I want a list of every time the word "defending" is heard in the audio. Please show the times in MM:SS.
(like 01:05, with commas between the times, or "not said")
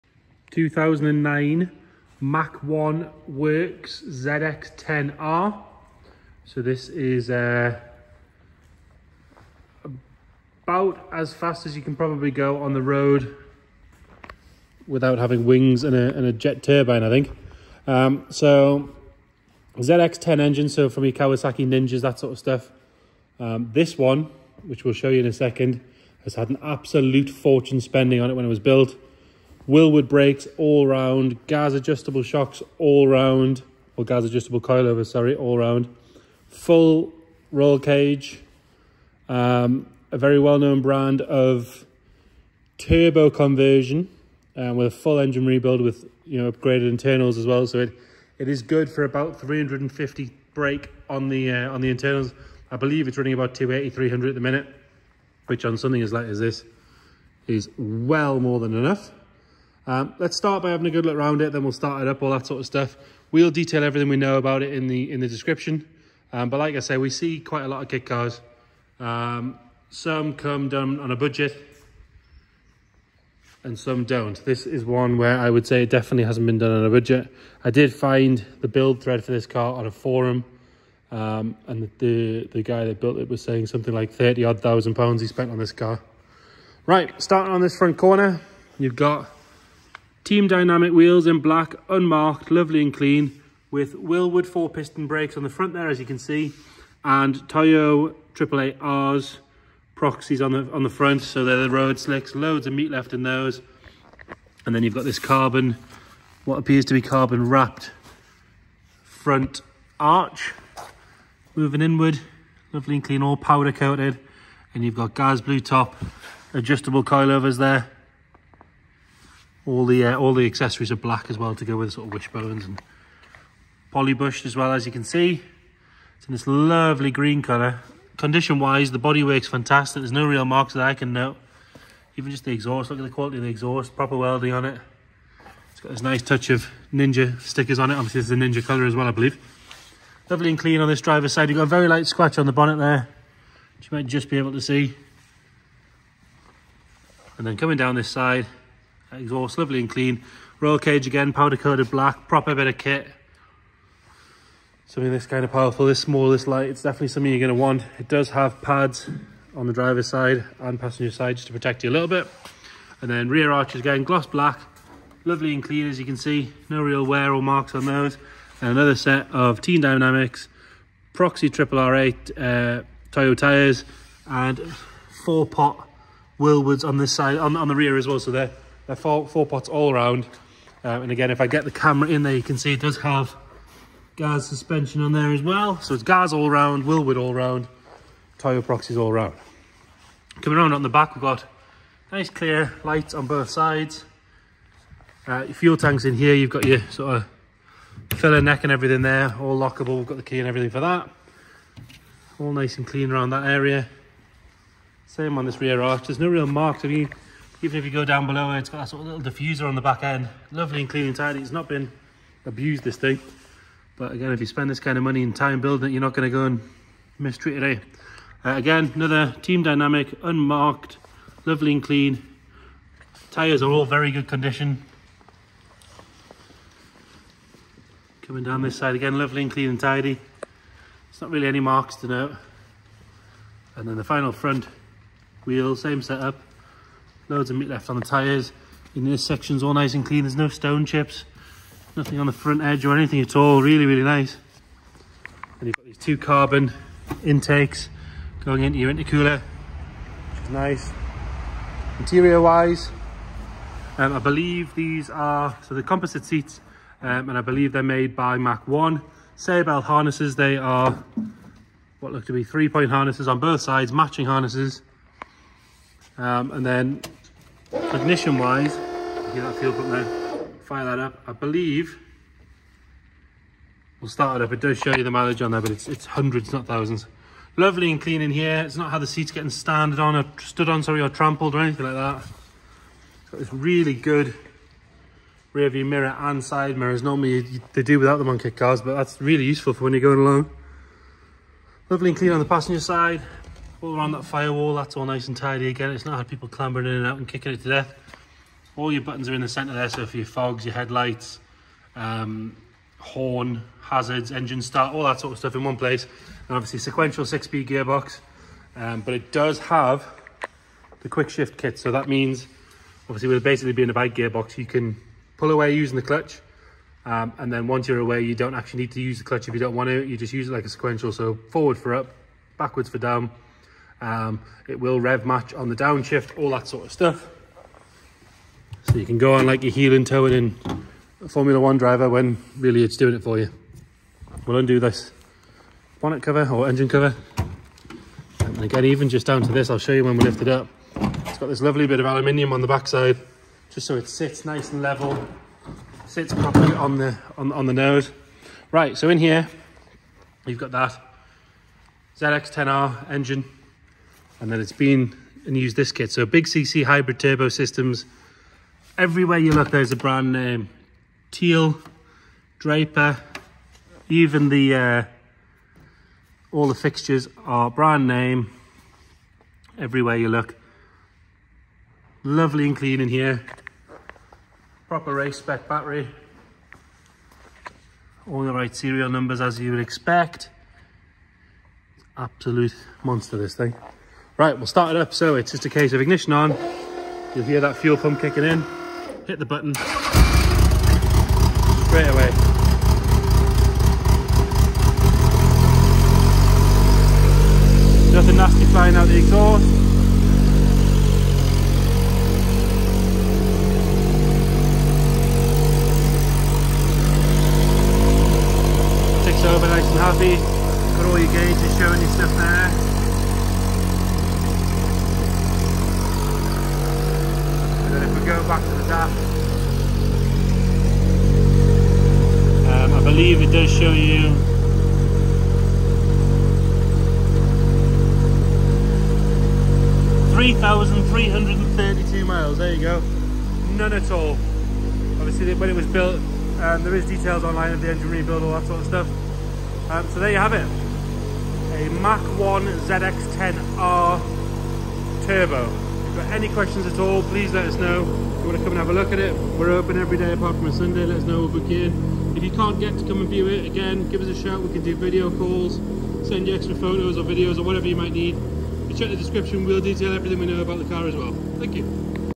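not said.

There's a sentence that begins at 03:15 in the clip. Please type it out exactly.
Uh, fuel tanks in here, you've got your sort of filler neck and everything there, all lockable.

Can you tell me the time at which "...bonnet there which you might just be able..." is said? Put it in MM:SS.
02:22.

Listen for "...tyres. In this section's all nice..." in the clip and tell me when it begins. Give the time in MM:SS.
03:58.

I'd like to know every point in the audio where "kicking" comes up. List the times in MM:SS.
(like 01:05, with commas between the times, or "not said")
04:57, 06:28.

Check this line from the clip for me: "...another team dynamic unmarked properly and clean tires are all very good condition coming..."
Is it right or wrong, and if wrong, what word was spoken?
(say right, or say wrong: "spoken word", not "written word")
wrong: "lovely", not "properly".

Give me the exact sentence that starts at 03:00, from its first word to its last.
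Um, and again, if I get the camera in there, you can see it does have gas suspension on there as well.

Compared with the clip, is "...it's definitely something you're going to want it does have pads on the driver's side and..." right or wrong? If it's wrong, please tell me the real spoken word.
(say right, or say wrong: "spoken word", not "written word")
right.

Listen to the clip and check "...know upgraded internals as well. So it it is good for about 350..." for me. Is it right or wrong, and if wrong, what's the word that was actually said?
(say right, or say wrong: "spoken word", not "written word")
right.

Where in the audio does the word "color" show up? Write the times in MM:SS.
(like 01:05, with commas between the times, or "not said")
02:07, 02:18.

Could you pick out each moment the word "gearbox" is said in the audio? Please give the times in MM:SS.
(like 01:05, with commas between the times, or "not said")
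05:07, 05:14.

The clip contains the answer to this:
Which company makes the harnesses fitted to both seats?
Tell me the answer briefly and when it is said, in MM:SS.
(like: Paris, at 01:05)
Sabelt, at 04:19.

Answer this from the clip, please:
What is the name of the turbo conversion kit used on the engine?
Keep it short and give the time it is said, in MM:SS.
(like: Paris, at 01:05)
Big CC hybrid turbo, at 05:56.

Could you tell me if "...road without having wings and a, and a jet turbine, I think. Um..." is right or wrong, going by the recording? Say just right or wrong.
right.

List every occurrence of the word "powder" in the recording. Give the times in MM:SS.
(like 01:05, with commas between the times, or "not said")
01:53, 02:31.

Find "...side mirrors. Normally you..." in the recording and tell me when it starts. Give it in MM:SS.
04:46.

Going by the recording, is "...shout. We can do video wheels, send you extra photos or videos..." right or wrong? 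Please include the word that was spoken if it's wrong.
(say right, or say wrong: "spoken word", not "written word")
wrong: "calls", not "wheels".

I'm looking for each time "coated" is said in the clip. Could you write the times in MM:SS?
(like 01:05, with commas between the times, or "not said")
01:53, 02:31.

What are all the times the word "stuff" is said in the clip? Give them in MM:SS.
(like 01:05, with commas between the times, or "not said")
00:22, 01:02, 05:05, 05:26, 06:52, 07:18.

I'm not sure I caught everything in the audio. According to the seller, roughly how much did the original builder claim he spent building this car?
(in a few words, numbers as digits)
30 odd thousand pounds.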